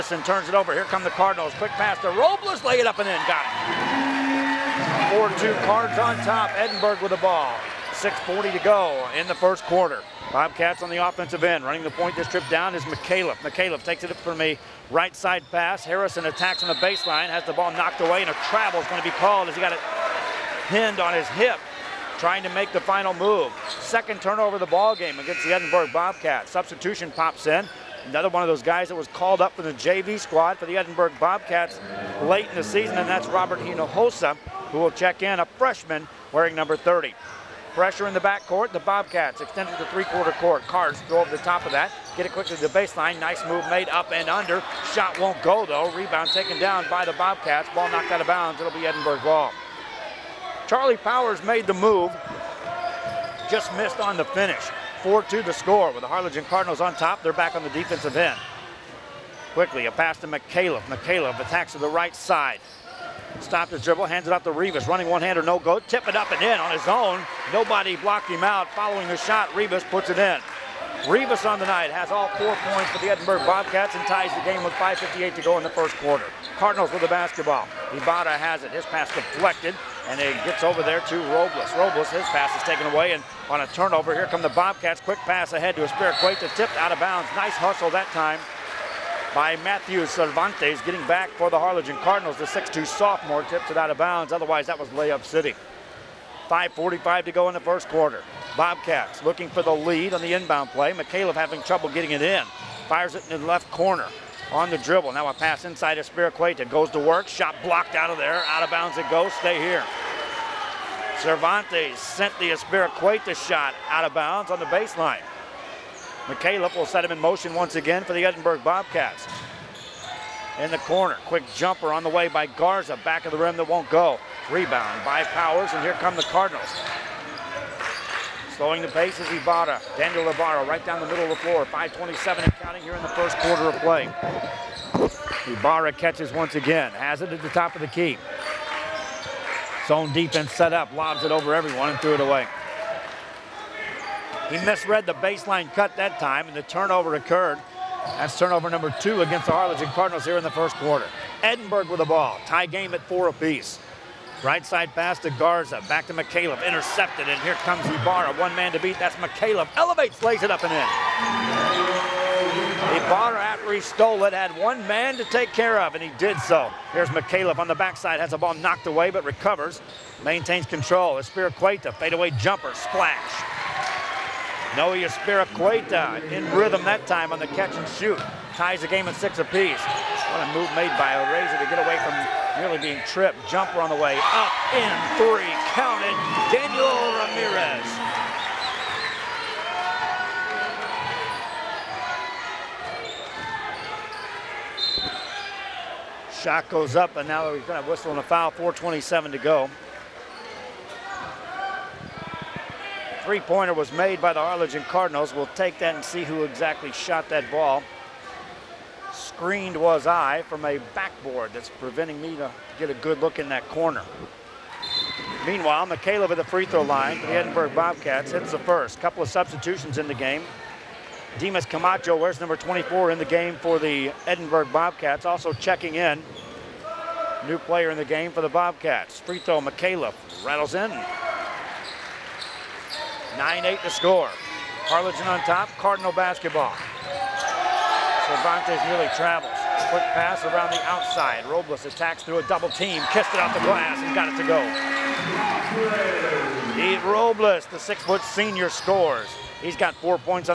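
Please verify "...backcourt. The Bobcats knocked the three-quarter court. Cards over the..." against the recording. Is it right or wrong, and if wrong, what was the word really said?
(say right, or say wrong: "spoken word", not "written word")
wrong: "extended", not "knocked".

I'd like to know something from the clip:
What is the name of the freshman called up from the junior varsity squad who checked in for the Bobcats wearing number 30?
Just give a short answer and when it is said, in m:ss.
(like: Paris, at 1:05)
Robert Hinojosa, at 0:33.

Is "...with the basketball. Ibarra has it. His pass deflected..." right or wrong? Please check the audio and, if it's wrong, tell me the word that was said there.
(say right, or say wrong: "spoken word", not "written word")
right.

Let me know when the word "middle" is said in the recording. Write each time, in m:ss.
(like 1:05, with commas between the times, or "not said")
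2:11.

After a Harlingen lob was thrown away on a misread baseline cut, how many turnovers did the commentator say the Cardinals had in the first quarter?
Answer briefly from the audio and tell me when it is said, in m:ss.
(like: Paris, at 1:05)
2, at 2:29.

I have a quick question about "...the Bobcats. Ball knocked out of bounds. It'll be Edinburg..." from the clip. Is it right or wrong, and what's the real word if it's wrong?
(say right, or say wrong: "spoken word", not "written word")
right.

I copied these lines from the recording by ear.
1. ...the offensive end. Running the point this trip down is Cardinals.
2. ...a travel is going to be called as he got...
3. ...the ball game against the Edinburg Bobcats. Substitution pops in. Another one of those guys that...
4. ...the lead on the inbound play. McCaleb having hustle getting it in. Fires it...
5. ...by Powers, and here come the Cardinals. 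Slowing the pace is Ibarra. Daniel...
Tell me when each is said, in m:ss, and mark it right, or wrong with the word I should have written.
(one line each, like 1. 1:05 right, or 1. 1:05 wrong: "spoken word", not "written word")
1. 0:10 wrong: "McCaleb", not "Cardinals"
2. 0:18 right
3. 0:24 right
4. 1:39 wrong: "trouble", not "hustle"
5. 2:05 right.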